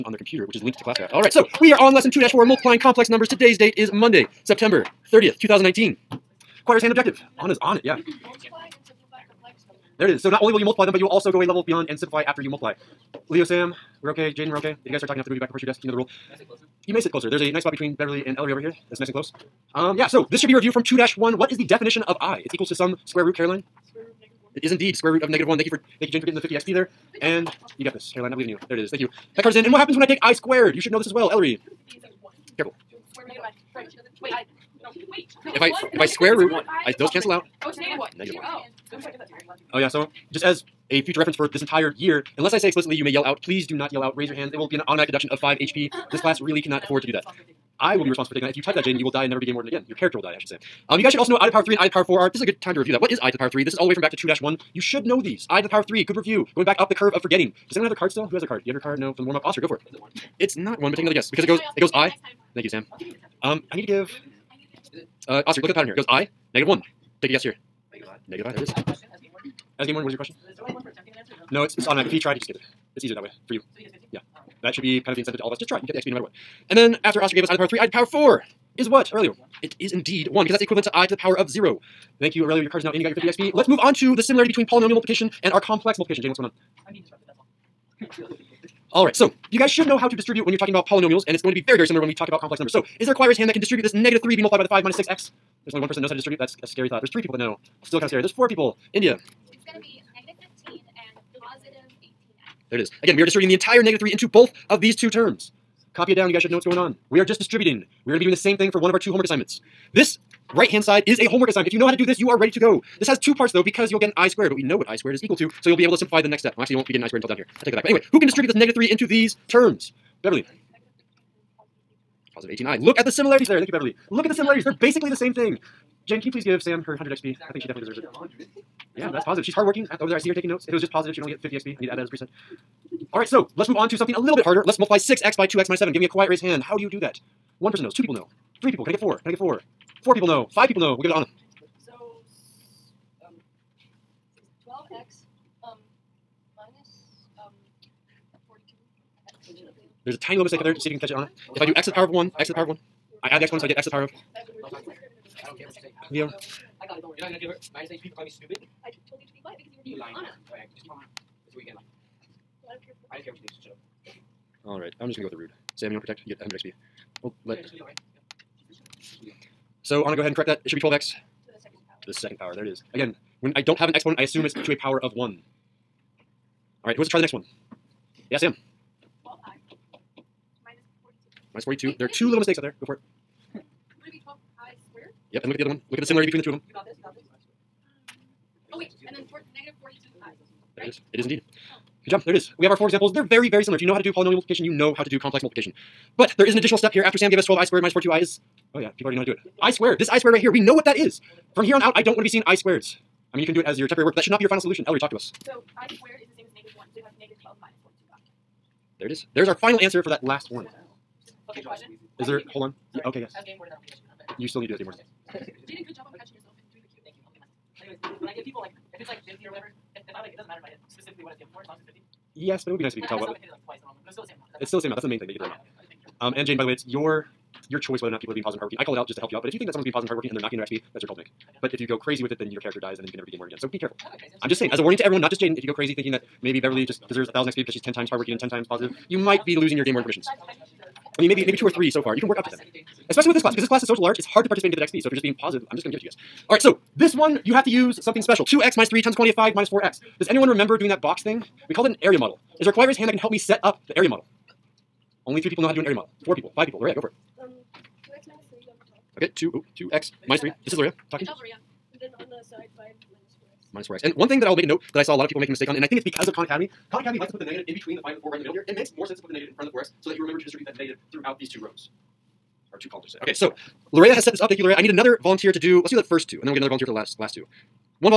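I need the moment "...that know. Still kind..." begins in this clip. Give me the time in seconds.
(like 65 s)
97 s.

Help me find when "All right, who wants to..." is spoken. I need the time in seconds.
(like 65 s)
176 s.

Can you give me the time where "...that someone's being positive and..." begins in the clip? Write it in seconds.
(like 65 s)
229 s.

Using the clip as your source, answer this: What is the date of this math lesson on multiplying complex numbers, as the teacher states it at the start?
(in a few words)
Monday, September 30th, 2019.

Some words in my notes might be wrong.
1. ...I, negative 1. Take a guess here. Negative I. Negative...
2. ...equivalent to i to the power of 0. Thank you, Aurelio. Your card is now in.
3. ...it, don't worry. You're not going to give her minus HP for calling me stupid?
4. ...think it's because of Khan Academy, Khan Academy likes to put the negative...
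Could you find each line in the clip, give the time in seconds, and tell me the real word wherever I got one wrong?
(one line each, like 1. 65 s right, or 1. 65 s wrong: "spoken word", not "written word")
1. 66 s right
2. 80 s right
3. 156 s right
4. 265 s right.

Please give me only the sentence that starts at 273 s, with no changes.
Okay, so Larea has set this up.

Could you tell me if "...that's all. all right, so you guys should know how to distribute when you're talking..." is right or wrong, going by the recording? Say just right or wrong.
right.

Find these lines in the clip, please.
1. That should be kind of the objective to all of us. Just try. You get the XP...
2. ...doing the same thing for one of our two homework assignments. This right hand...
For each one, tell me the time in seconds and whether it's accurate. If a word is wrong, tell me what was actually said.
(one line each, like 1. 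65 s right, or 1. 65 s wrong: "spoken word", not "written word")
1. 74 s wrong: "incentive", not "objective"
2. 108 s right.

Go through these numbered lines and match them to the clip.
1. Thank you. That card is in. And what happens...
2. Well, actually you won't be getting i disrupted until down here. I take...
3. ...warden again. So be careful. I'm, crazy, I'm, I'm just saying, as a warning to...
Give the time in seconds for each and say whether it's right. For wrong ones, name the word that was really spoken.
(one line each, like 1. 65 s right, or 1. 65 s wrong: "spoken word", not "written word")
1. 28 s right
2. 116 s wrong: "squared", not "disrupted"
3. 233 s right.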